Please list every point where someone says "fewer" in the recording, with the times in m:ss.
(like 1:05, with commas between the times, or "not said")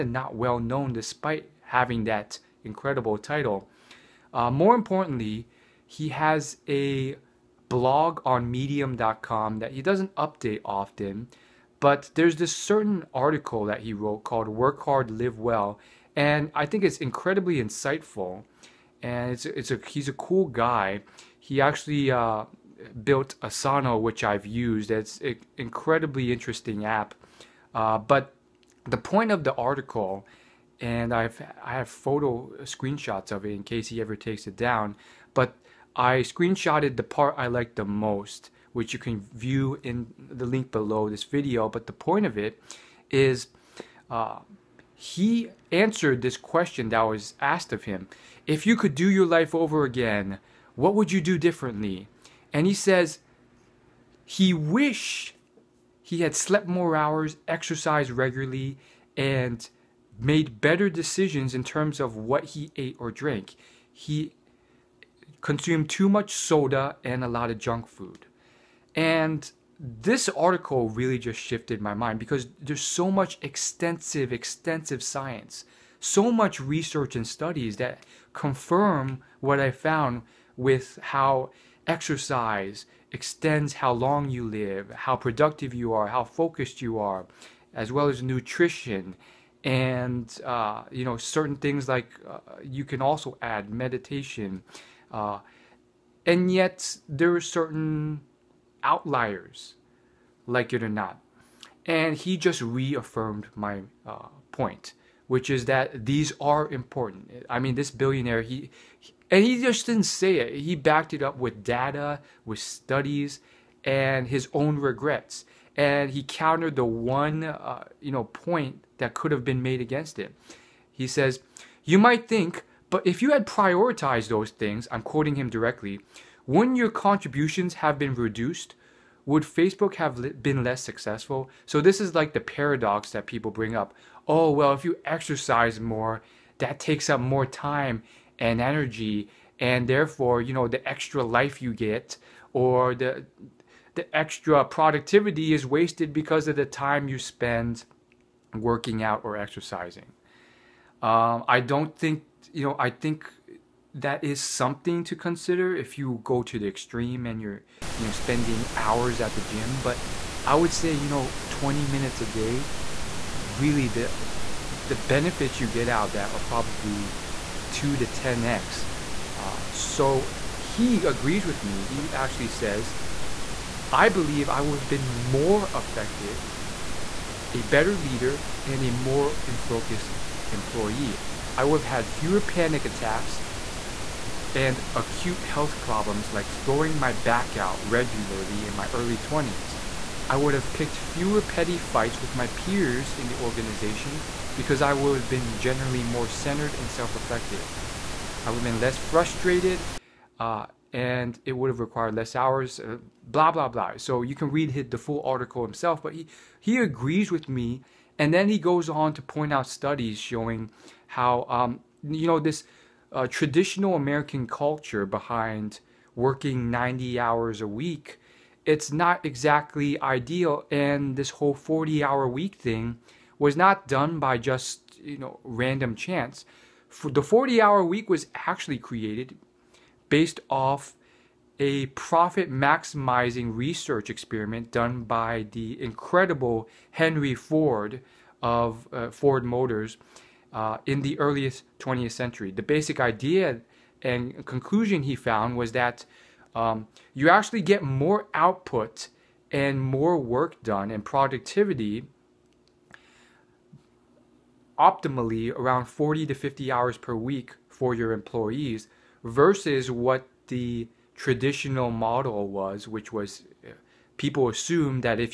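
3:02, 3:10.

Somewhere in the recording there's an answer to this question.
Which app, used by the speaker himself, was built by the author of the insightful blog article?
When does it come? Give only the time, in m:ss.
0:23.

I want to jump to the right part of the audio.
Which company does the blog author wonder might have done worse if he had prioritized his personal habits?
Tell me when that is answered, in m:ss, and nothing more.
2:09.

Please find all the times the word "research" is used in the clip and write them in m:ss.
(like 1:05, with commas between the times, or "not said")
1:16, 3:53.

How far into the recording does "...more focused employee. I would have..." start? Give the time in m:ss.
2:58.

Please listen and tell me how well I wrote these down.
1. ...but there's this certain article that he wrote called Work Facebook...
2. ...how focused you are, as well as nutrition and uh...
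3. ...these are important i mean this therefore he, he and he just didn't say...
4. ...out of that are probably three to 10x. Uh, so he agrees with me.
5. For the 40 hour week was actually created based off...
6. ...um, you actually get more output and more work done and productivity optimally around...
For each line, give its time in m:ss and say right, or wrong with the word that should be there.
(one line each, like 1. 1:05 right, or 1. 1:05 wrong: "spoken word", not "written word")
1. 0:11 wrong: "Hard", not "Facebook"
2. 1:26 right
3. 1:46 wrong: "billionaire", not "therefore"
4. 2:45 wrong: "two", not "three"
5. 3:46 right
6. 4:06 right.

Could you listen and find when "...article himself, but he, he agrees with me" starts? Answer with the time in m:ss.
3:25.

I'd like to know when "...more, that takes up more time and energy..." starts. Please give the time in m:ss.
2:15.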